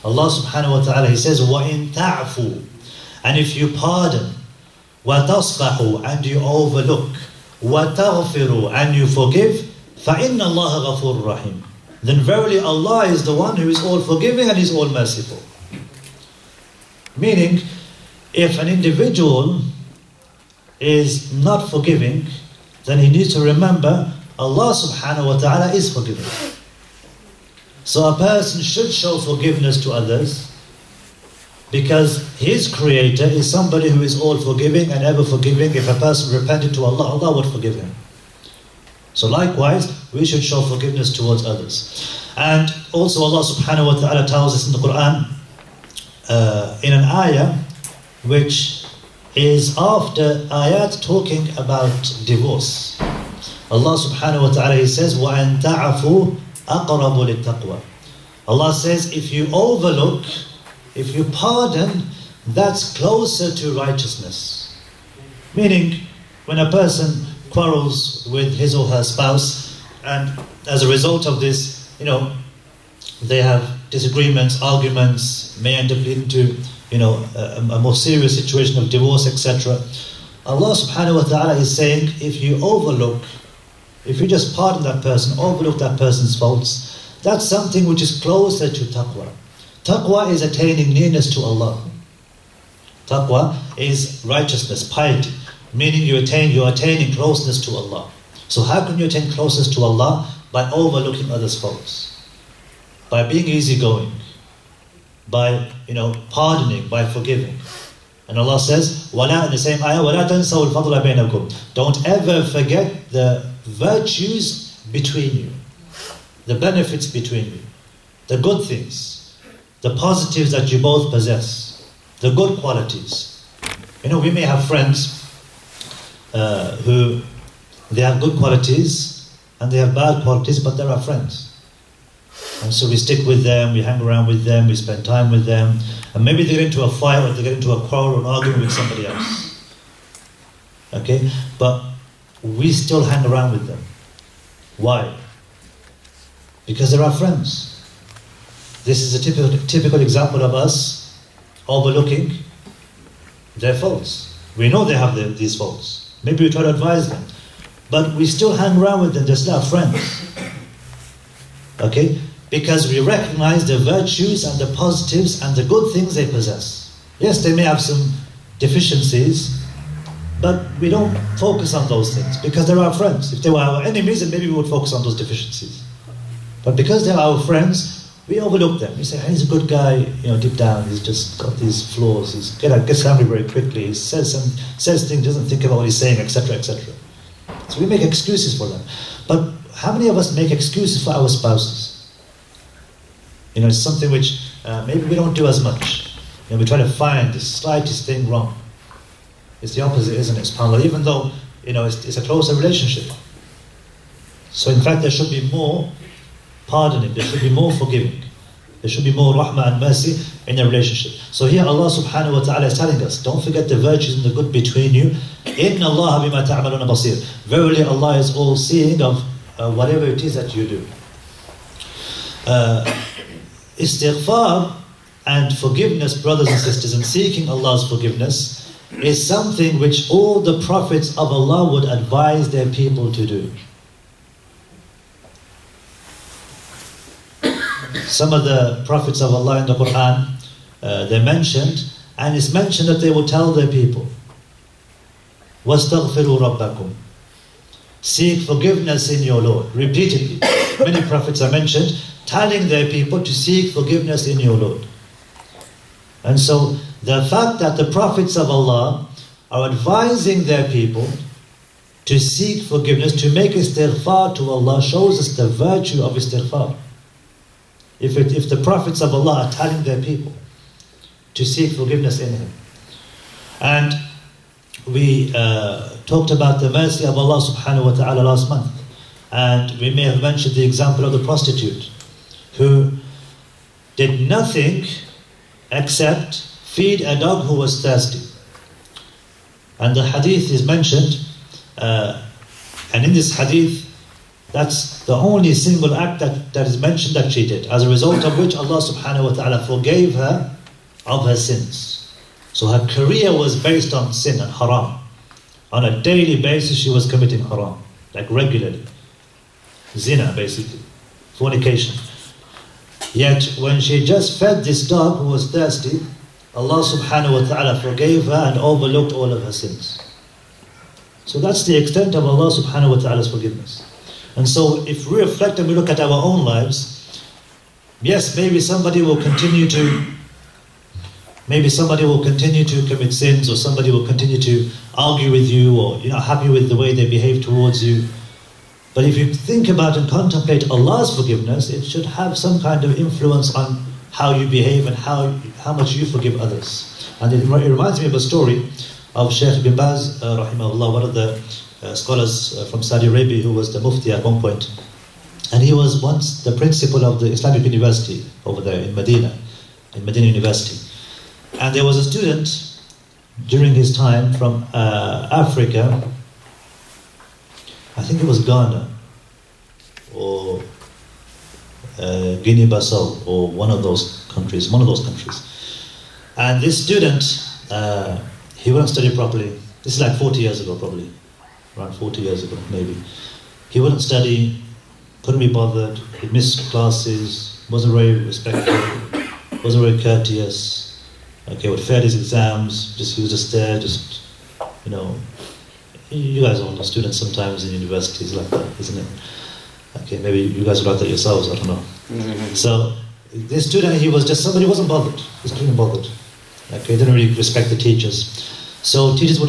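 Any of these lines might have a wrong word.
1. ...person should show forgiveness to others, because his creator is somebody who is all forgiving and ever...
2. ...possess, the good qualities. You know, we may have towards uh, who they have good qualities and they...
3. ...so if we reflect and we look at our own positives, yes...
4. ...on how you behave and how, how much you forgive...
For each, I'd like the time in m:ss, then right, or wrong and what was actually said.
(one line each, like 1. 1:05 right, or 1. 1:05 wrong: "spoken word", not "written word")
1. 0:28 right
2. 2:01 wrong: "friends", not "towards"
3. 5:24 wrong: "lives", not "positives"
4. 5:43 right.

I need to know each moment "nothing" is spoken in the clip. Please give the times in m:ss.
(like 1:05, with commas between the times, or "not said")
4:44.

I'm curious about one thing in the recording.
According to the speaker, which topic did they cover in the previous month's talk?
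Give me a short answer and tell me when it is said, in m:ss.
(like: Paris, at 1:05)
mercy of Allah, at 4:36.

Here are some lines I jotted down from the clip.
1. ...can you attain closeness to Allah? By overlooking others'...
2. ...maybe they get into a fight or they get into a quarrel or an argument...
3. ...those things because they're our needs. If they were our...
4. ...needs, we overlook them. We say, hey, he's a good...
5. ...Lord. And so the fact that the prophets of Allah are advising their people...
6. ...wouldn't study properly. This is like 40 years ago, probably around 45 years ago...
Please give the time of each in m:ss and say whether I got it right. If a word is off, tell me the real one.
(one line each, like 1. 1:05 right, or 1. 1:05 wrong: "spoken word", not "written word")
1. 1:38 right
2. 2:16 right
3. 2:51 wrong: "friends", not "needs"
4. 2:57 wrong: "friends", not "needs"
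5. 4:14 right
6. 6:18 wrong: "40", not "45".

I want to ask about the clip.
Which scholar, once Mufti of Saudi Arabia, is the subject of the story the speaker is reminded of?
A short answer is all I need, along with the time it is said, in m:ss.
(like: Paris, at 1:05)
Sheikh bin Baz, at 5:49.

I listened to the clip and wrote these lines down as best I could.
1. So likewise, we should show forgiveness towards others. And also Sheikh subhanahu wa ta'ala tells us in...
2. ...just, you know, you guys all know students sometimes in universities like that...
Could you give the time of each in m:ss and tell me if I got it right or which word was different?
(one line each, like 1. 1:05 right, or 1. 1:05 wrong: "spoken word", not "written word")
1. 0:39 wrong: "Allah", not "Sheikh"
2. 6:33 right.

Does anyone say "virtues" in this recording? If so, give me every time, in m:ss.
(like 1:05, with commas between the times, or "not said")
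1:53, 2:43, 3:33, 4:25.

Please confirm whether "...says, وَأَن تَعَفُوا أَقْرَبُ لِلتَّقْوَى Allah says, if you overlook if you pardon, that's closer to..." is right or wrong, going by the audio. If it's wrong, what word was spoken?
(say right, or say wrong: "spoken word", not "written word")
right.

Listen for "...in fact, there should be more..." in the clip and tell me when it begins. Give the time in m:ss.
3:24.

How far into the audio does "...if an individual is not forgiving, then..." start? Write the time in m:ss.
0:18.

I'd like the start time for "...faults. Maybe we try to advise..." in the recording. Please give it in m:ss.
2:35.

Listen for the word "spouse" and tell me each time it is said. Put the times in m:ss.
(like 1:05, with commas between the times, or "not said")
1:09, 3:11.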